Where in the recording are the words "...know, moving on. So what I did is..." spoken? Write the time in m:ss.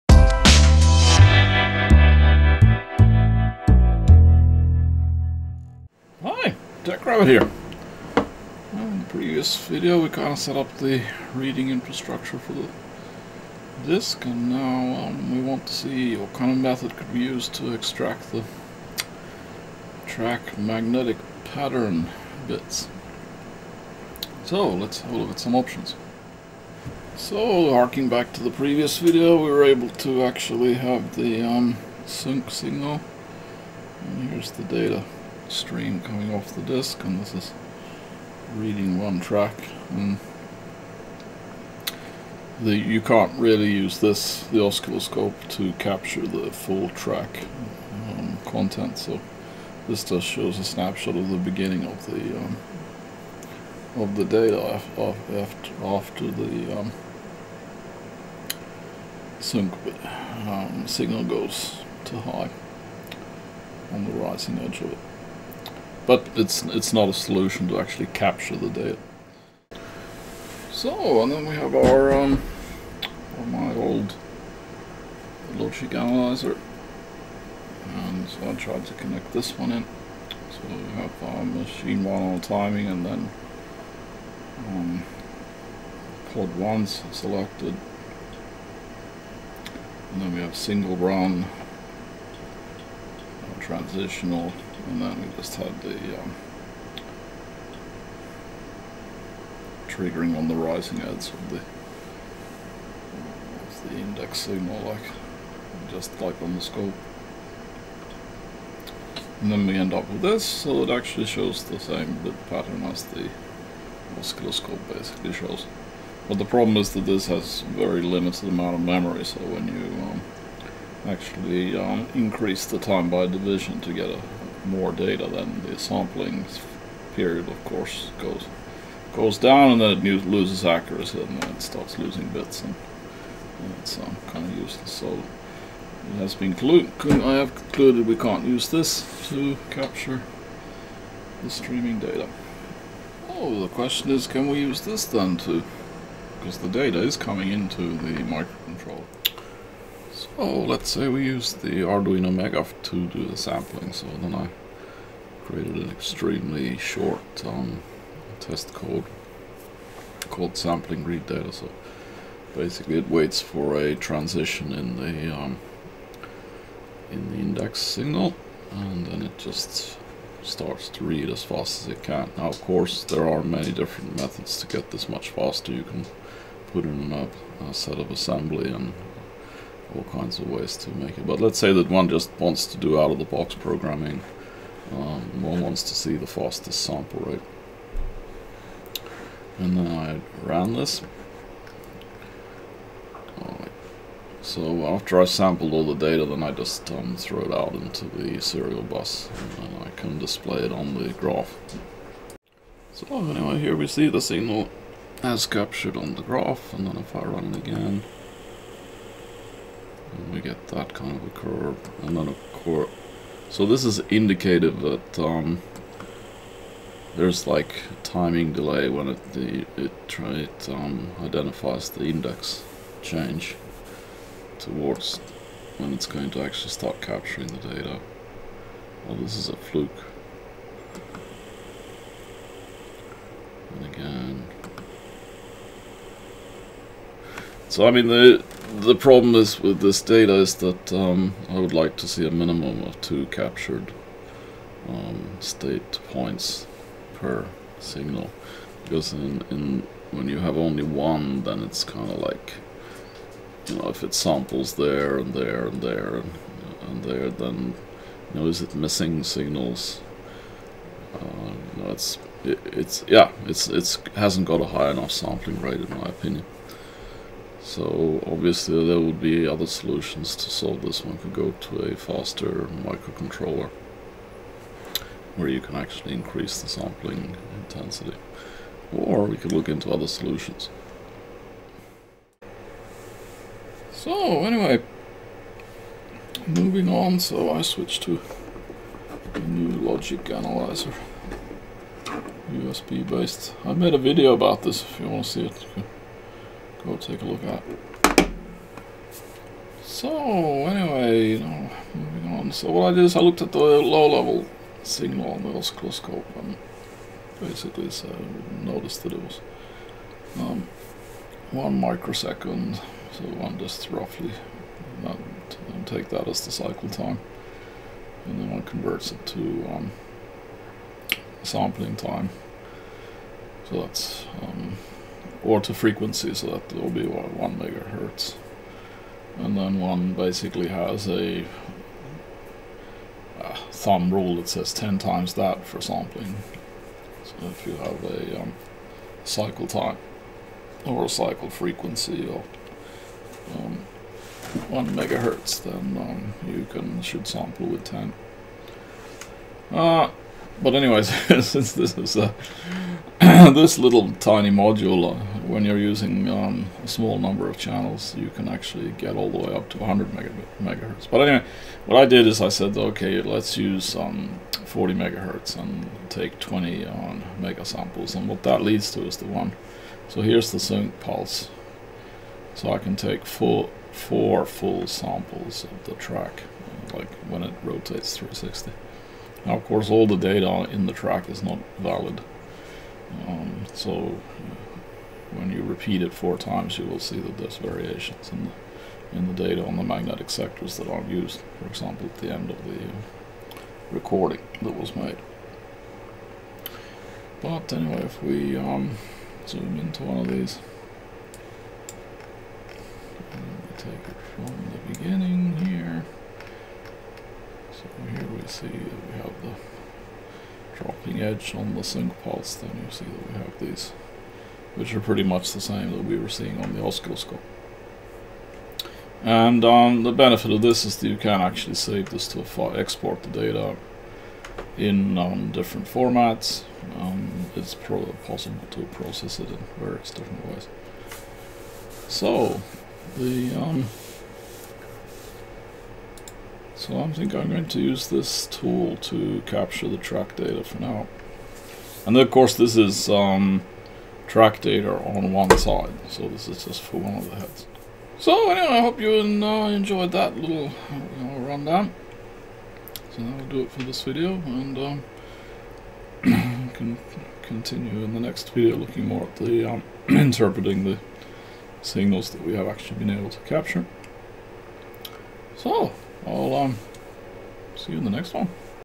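5:01.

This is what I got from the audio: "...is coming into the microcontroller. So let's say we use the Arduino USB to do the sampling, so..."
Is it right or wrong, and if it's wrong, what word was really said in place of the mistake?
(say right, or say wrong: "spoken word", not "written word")
wrong: "Megaf", not "USB".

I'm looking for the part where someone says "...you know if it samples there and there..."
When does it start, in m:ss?
4:13.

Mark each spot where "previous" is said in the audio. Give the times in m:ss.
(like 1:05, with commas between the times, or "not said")
0:09, 0:28.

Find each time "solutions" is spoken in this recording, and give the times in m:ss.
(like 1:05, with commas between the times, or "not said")
1:07, 4:29, 4:40.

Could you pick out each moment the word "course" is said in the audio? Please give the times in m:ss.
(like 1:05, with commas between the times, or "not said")
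2:07, 2:52, 6:19, 7:22.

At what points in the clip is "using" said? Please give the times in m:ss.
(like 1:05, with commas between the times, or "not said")
5:55.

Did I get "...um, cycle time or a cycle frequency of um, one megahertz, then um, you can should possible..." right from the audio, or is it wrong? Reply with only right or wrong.
wrong.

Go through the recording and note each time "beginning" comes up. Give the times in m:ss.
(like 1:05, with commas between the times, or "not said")
0:51, 6:44.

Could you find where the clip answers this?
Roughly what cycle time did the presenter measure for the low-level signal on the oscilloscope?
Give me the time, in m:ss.
5:11.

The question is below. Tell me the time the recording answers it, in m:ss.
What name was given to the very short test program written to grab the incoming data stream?
2:40.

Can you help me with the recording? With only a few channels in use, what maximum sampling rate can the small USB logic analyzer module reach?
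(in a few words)
100 MHz.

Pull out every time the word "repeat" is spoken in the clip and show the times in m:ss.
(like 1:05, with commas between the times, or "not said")
6:25.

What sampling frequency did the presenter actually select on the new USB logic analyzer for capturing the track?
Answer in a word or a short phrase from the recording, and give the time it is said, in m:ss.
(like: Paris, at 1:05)
40 MHz, at 6:04.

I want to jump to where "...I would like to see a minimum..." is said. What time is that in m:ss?
4:01.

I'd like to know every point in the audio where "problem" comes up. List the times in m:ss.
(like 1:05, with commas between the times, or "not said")
1:56, 3:58.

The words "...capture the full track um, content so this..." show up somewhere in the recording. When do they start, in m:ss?
0:45.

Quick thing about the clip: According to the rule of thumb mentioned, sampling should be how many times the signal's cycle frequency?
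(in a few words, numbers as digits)
10 times.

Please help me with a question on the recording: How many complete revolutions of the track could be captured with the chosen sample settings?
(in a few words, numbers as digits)
4.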